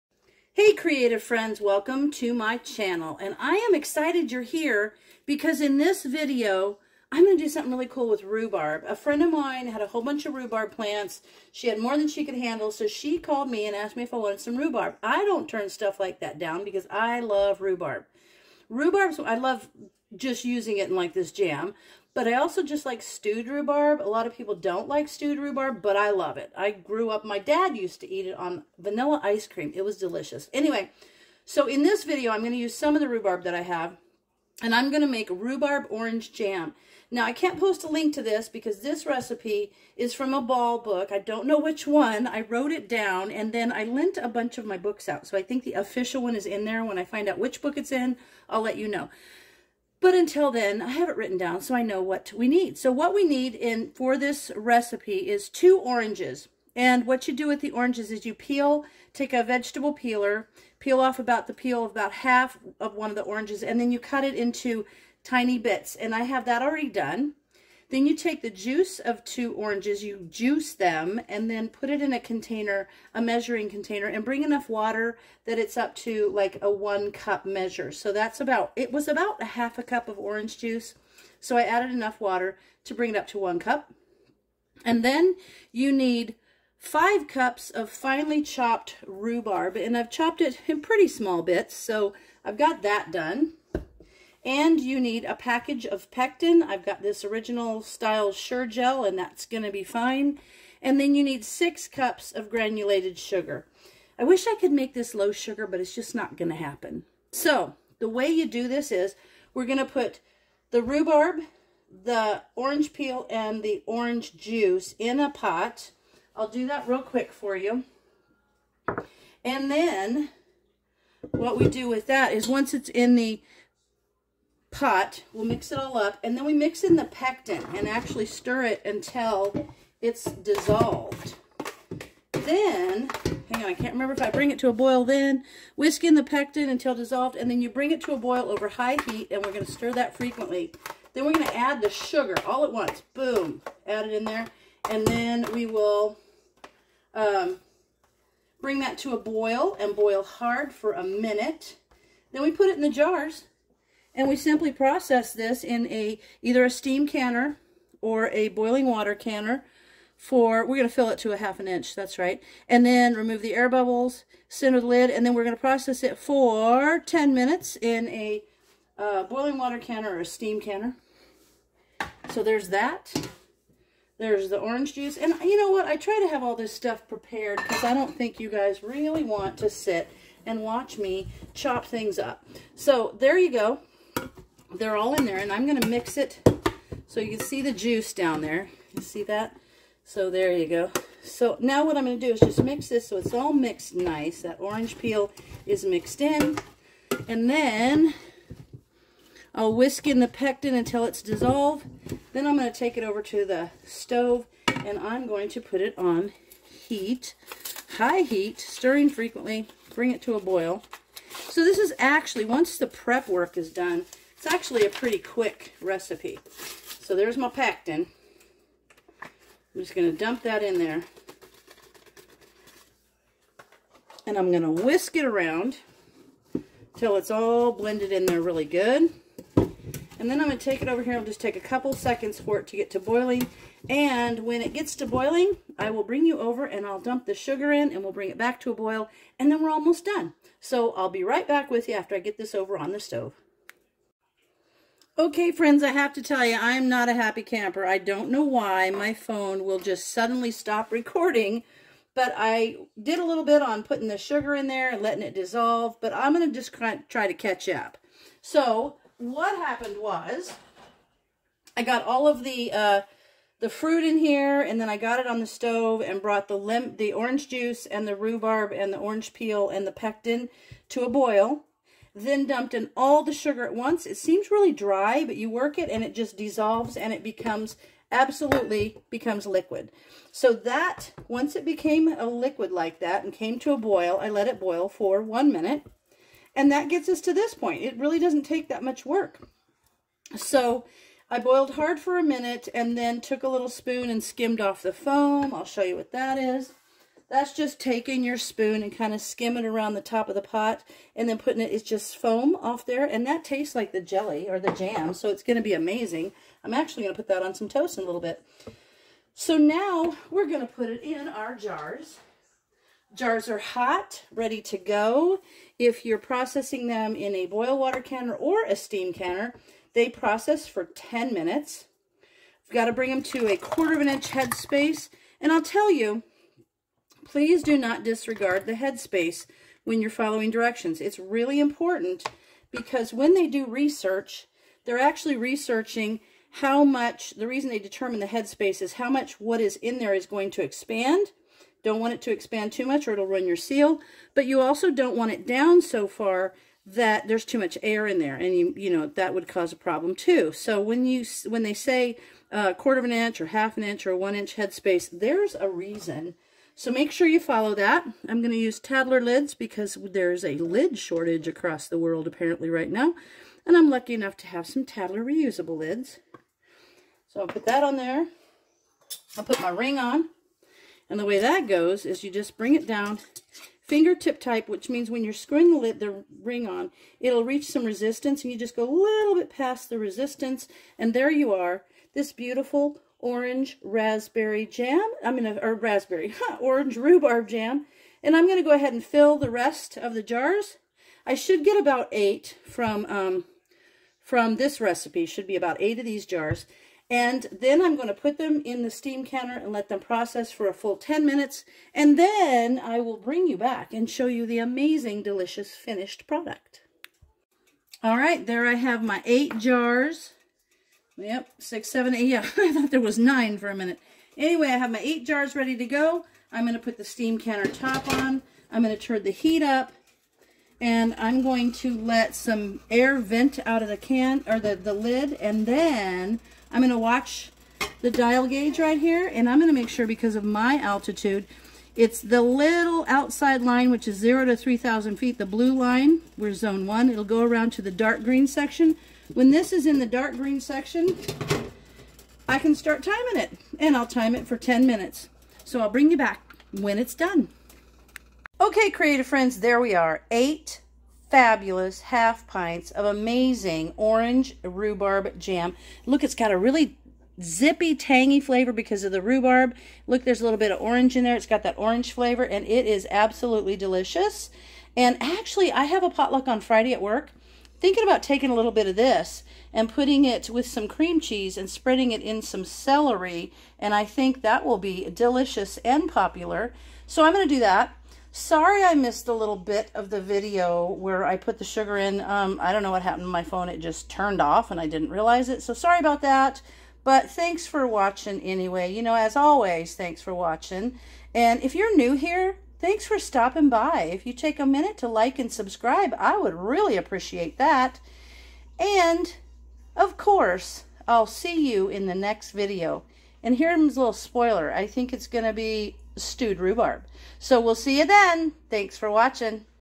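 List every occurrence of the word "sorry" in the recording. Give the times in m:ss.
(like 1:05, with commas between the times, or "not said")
7:58, 8:05.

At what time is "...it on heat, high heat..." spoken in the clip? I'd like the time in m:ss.
3:25.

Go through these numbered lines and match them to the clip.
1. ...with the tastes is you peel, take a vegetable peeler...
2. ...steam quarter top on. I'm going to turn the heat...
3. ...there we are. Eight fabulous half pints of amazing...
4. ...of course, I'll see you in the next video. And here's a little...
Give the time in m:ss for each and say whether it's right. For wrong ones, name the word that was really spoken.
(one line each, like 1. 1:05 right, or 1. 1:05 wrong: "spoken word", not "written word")
1. 0:57 wrong: "oranges", not "tastes"
2. 6:57 wrong: "canner", not "quarter"
3. 7:29 right
4. 8:19 right.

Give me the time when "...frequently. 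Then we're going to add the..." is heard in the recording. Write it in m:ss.
2:20.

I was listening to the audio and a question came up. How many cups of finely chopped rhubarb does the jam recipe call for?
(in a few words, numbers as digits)
5.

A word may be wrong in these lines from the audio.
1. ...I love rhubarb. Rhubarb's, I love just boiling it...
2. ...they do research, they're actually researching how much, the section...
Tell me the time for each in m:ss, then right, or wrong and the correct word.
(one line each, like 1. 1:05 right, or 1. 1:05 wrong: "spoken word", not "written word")
1. 0:16 wrong: "using", not "boiling"
2. 5:33 wrong: "reason", not "section".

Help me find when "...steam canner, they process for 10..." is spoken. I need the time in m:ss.
5:18.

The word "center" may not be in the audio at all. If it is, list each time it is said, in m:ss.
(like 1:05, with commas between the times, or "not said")
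2:44.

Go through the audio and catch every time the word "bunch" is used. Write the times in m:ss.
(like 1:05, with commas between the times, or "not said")
0:10, 0:44.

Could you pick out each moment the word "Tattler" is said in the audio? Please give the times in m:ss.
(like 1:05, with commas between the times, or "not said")
5:58, 6:04.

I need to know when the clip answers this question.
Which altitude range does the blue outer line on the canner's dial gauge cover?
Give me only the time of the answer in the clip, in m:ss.
7:14.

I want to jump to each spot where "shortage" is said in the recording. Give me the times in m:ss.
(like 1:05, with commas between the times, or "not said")
6:00.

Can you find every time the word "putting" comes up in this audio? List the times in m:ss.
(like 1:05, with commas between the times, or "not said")
4:13, 5:01, 7:49.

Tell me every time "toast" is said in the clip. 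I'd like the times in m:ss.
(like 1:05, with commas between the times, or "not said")
5:07.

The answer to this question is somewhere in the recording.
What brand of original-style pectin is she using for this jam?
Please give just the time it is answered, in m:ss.
1:38.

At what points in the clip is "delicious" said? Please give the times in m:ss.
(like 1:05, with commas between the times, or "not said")
0:29, 6:45, 7:43, 7:55.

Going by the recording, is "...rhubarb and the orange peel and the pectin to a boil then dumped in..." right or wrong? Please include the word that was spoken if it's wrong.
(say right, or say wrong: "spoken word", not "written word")
right.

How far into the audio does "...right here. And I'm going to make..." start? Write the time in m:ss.
7:08.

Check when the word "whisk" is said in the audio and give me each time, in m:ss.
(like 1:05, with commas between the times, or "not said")
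2:15, 3:19, 3:44.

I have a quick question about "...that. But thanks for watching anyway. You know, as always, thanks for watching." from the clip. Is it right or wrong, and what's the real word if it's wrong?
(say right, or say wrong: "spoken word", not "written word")
right.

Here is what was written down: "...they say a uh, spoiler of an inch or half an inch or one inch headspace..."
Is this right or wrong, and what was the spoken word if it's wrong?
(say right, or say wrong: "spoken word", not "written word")
wrong: "quarter", not "spoiler".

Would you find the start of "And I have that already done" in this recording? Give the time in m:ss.
1:05.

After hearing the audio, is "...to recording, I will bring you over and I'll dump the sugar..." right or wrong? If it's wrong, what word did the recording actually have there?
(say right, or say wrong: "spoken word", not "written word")
wrong: "boiling", not "recording".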